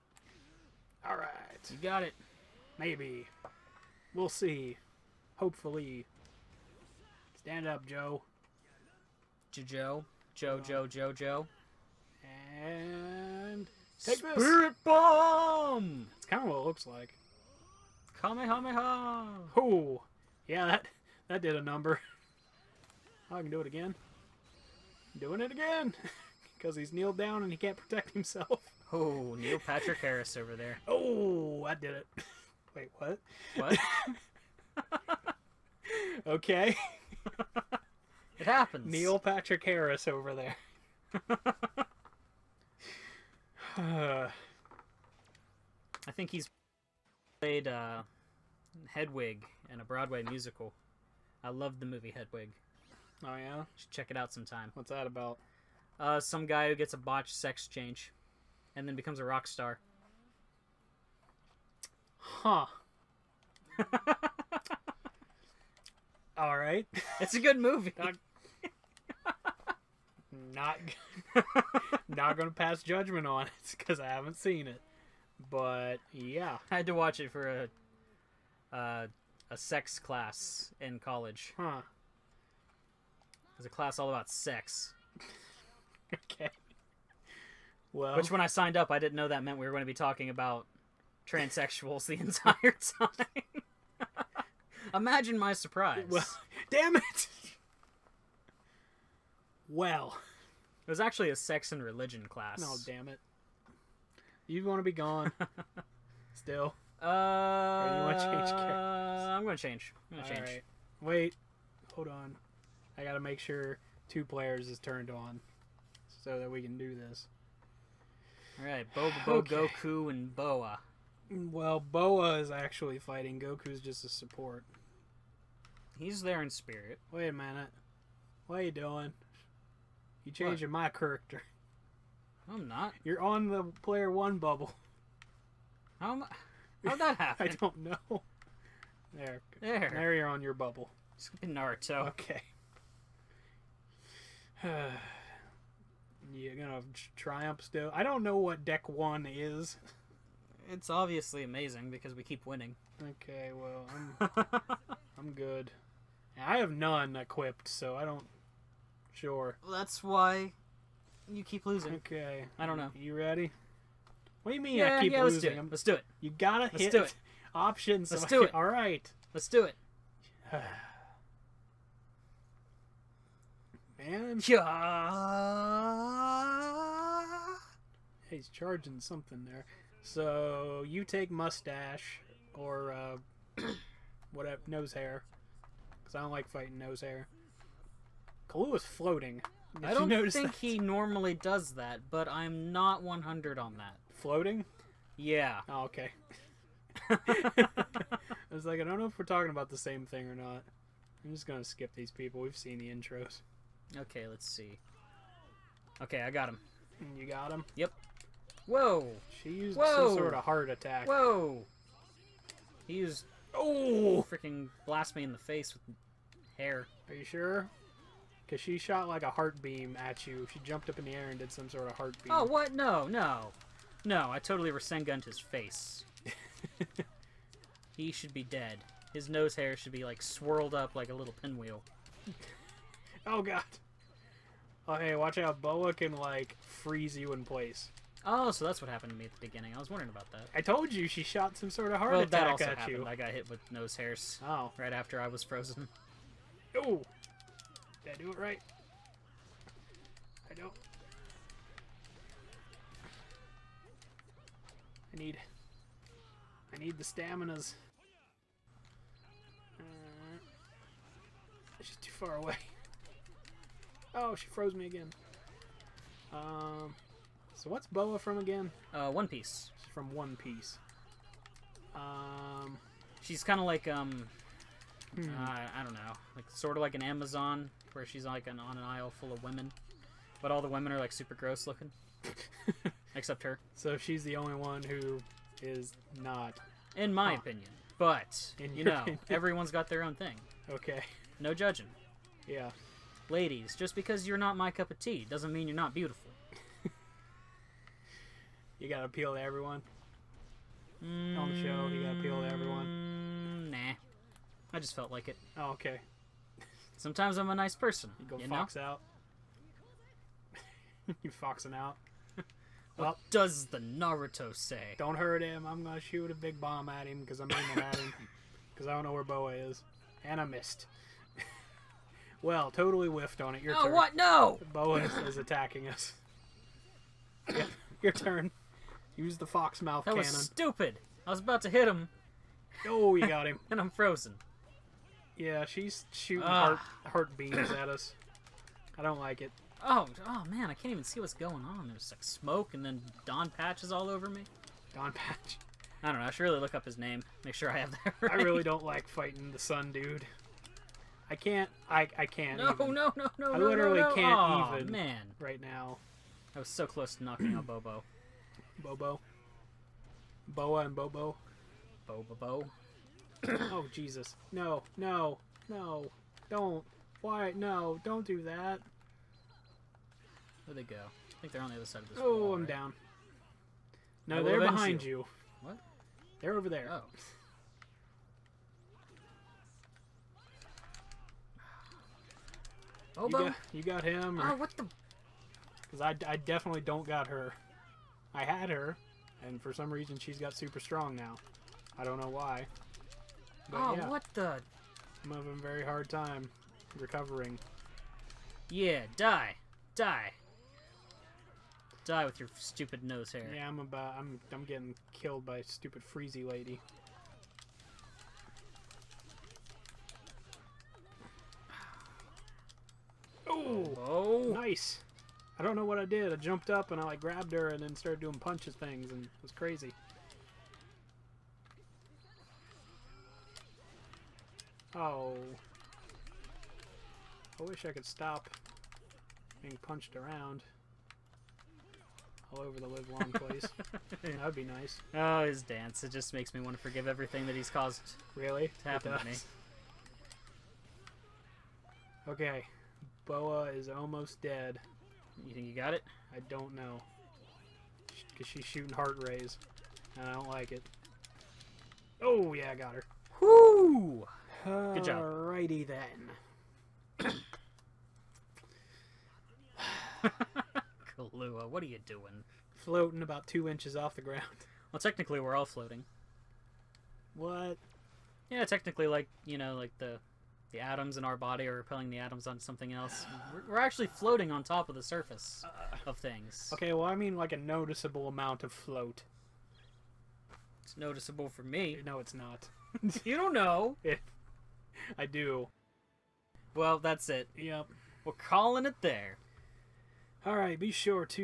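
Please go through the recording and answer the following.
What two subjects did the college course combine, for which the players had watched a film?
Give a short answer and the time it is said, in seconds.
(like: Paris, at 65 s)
sex and religion, at 101 s.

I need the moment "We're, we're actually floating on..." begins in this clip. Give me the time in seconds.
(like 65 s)
473 s.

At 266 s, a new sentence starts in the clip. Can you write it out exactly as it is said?
Um, so what's Boa from again?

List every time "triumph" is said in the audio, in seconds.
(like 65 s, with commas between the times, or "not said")
147 s.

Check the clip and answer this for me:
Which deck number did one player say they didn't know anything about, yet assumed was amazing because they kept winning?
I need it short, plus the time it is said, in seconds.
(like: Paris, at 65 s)
1, at 148 s.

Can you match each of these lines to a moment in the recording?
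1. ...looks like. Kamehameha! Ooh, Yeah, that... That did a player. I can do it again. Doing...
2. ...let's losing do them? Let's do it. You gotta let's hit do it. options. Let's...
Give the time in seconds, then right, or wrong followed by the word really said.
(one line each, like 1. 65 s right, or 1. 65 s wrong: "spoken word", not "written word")
1. 16 s wrong: "number", not "player"
2. 165 s right.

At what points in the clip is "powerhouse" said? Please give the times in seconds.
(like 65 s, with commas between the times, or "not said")
not said.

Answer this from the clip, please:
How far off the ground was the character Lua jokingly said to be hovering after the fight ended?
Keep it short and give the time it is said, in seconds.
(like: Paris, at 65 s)
two inches, at 463 s.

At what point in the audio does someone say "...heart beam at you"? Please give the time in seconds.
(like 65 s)
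219 s.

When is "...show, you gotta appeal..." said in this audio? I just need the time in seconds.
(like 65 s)
301 s.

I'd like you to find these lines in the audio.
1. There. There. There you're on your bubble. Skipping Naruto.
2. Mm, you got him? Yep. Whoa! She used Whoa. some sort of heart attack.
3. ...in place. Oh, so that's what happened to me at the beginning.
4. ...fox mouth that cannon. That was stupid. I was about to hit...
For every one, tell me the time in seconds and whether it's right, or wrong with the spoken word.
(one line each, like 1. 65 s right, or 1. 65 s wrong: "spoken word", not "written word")
1. 139 s right
2. 207 s right
3. 237 s right
4. 329 s right.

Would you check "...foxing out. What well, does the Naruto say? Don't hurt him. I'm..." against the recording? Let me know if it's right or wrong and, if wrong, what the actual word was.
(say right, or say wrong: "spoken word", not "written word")
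right.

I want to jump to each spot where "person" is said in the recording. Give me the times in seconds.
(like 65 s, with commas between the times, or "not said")
307 s.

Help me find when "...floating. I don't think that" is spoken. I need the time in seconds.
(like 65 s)
188 s.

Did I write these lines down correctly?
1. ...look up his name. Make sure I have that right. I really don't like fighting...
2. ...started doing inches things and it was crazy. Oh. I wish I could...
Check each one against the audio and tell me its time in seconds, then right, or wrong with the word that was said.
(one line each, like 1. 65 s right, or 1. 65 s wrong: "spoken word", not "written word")
1. 346 s right
2. 417 s wrong: "punches", not "inches".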